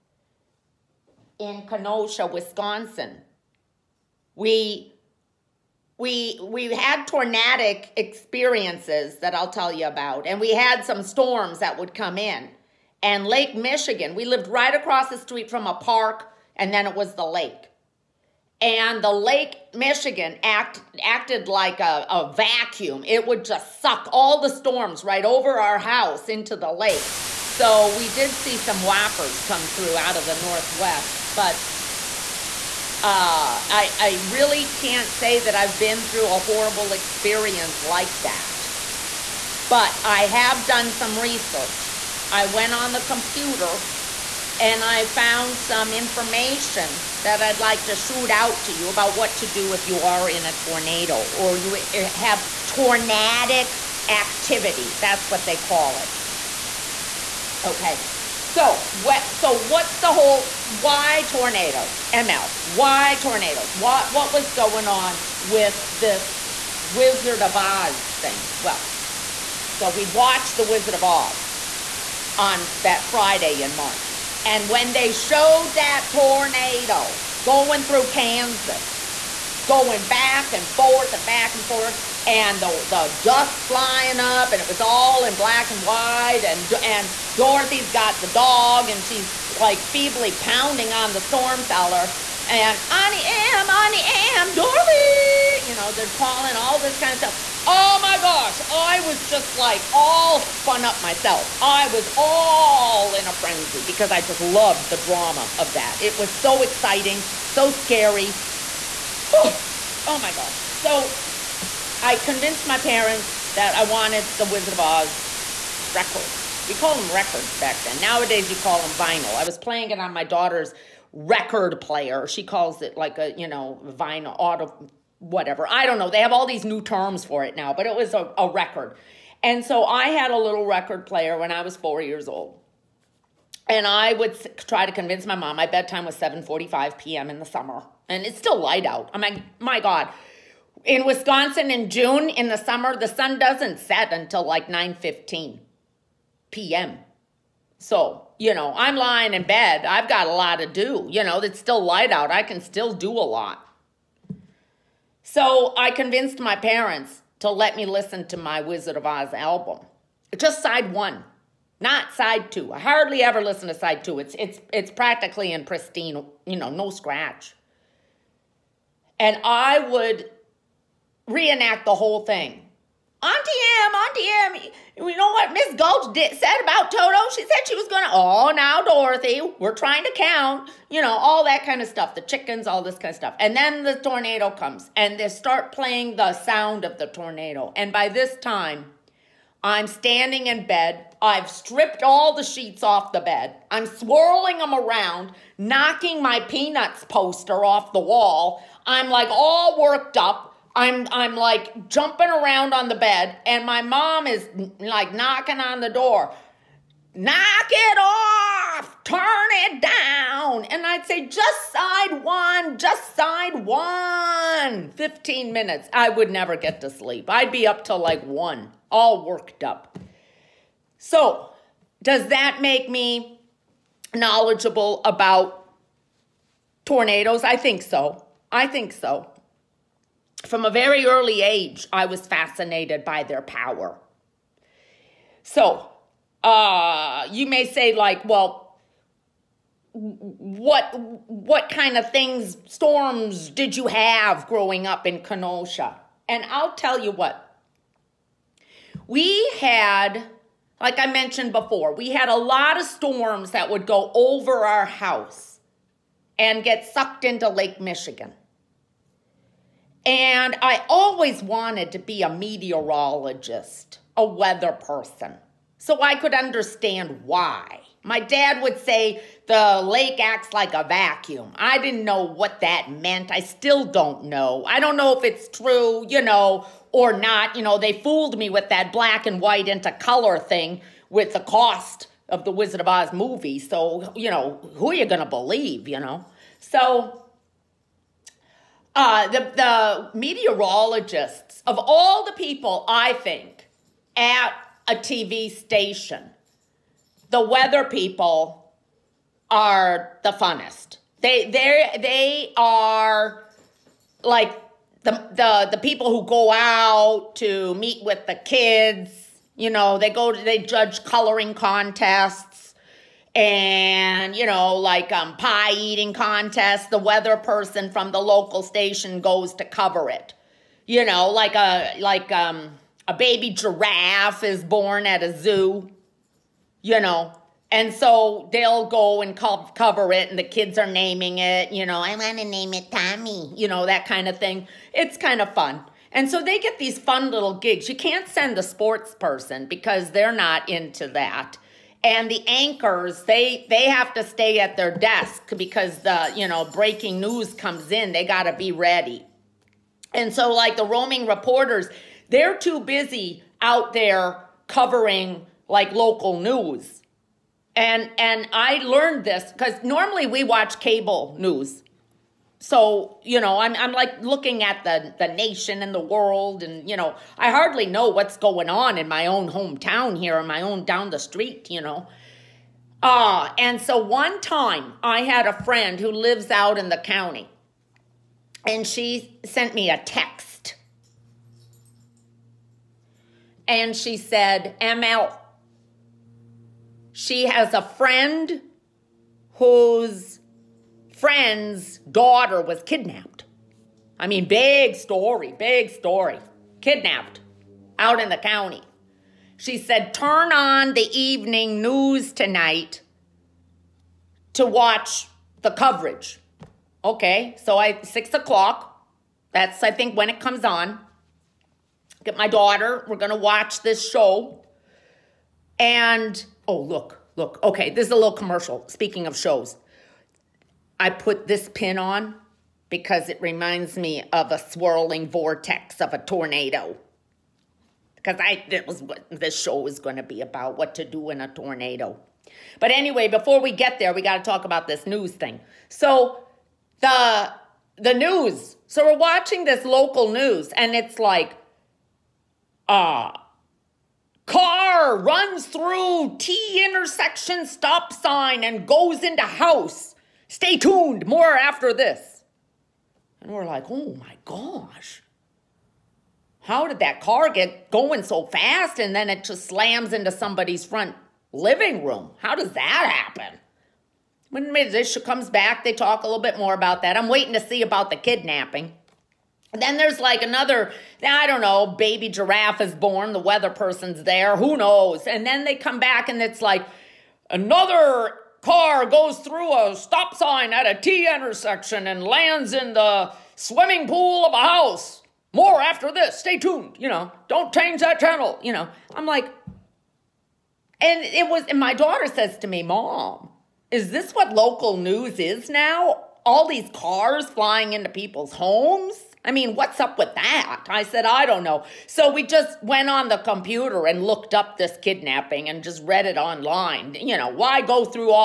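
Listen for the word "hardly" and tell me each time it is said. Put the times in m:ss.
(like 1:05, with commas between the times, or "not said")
2:42, 6:07.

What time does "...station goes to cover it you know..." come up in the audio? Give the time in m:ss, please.
5:18.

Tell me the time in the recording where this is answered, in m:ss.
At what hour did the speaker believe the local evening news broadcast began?
6:48.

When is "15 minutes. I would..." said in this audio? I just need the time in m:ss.
3:34.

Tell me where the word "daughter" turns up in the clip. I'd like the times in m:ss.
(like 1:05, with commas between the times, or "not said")
2:00, 6:31, 6:52, 8:11.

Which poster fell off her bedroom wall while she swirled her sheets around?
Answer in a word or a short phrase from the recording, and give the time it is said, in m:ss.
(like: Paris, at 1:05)
Peanuts poster, at 3:16.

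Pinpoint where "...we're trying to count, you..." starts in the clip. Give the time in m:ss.
2:59.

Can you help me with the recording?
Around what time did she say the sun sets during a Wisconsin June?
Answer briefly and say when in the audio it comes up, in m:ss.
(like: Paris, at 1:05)
9:15 p.m., at 2:24.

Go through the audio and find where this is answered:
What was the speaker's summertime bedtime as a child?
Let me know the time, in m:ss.
2:16.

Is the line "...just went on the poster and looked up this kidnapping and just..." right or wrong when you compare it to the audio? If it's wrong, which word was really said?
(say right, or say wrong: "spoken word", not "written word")
wrong: "computer", not "poster".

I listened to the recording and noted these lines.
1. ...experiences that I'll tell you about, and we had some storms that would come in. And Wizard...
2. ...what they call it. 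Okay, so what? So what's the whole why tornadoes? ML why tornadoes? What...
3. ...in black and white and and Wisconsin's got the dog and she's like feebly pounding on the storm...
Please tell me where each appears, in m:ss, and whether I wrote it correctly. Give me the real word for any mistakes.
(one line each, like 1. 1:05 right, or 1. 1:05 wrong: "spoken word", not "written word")
1. 0:07 wrong: "Lake", not "Wizard"
2. 0:55 right
3. 1:25 wrong: "Dorothy", not "Wisconsin".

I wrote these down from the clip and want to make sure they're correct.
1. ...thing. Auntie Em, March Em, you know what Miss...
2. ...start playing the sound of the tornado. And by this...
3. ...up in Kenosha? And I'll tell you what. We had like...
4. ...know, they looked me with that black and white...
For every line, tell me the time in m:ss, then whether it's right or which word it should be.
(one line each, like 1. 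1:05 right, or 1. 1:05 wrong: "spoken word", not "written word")
1. 2:52 wrong: "Auntie", not "March"
2. 3:05 right
3. 4:04 right
4. 4:37 wrong: "fooled", not "looked".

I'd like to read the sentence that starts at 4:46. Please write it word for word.
So uh, the, the meteorologists, of all the people, I think, at a TV station, the weather people are the funnest.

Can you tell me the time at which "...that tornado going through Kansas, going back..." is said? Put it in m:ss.
1:15.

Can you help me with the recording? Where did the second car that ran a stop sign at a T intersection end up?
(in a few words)
swimming pool.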